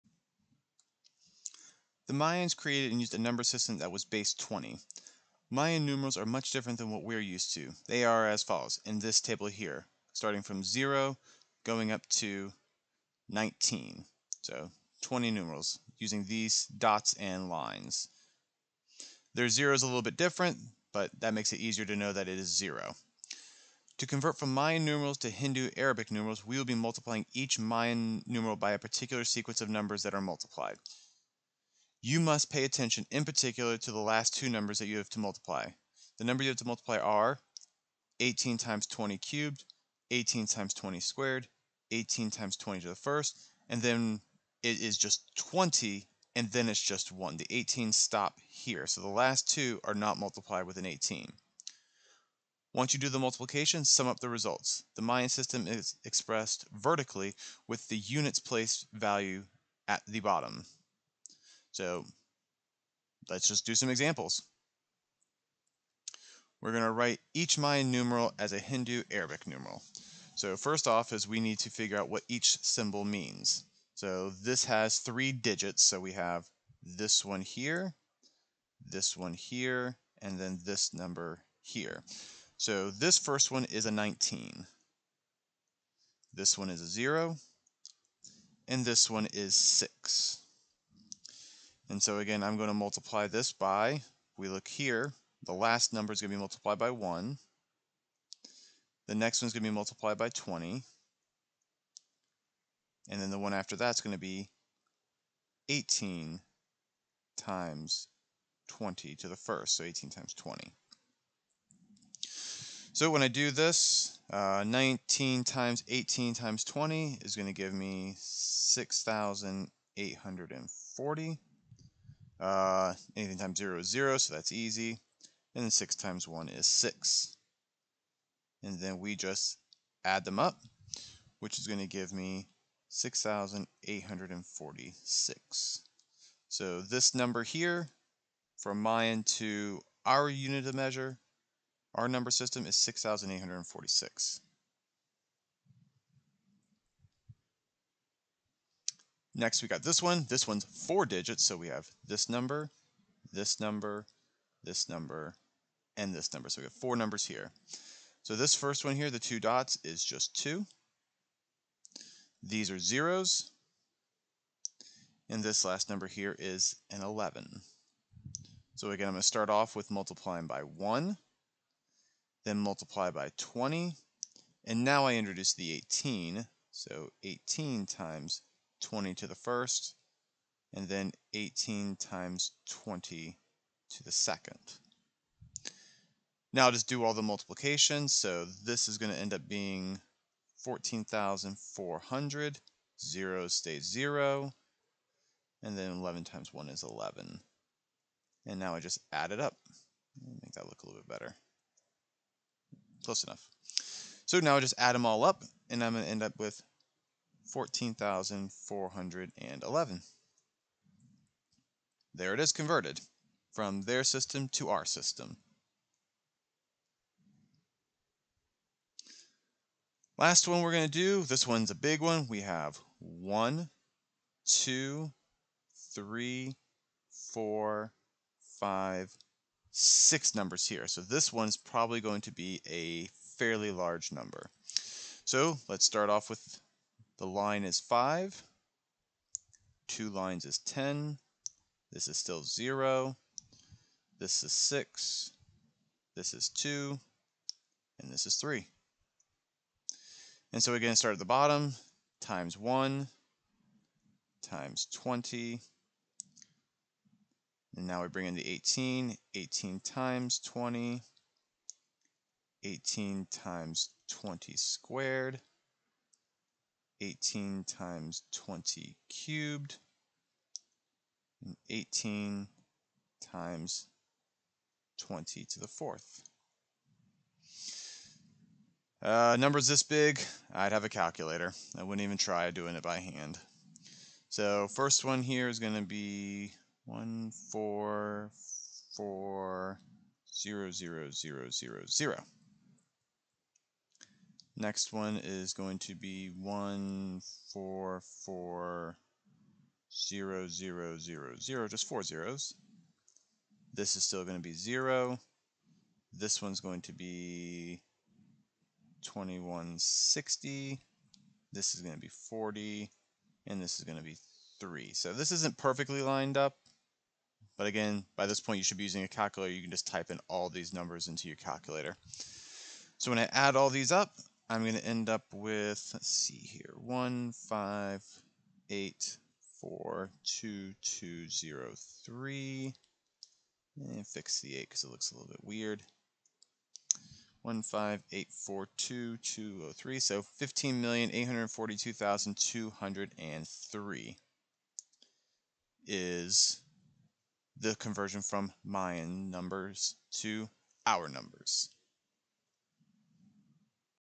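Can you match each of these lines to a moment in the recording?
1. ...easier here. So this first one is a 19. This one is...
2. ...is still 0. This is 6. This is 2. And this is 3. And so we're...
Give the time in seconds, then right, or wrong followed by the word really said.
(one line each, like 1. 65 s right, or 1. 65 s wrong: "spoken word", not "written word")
1. 80 s wrong: "number", not "easier"
2. 242 s right.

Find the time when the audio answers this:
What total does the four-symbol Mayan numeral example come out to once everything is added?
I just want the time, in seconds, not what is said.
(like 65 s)
207 s.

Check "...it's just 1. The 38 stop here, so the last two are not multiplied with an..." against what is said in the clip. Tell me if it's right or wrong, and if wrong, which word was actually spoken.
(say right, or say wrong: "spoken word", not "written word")
wrong: "18", not "38".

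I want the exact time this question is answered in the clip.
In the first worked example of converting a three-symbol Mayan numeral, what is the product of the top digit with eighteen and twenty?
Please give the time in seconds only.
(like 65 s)
118 s.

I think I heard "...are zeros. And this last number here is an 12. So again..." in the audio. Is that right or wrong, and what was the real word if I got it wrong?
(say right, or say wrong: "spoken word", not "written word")
wrong: "11", not "12".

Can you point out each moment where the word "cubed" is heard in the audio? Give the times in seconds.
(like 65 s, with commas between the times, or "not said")
39 s, 269 s.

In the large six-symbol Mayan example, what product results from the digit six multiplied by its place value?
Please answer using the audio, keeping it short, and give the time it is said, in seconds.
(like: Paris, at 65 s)
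2160, at 309 s.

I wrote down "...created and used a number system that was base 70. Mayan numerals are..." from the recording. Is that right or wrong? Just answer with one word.
wrong.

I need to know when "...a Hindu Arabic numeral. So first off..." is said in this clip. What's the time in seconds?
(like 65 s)
68 s.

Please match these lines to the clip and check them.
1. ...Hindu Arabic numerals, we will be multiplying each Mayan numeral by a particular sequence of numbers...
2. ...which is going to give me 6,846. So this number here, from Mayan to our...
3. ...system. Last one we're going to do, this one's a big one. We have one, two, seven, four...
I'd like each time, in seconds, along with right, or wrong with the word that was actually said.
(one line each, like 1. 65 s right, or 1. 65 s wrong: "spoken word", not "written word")
1. 25 s right
2. 131 s right
3. 214 s wrong: "three", not "seven".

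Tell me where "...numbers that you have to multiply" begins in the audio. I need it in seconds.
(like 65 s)
34 s.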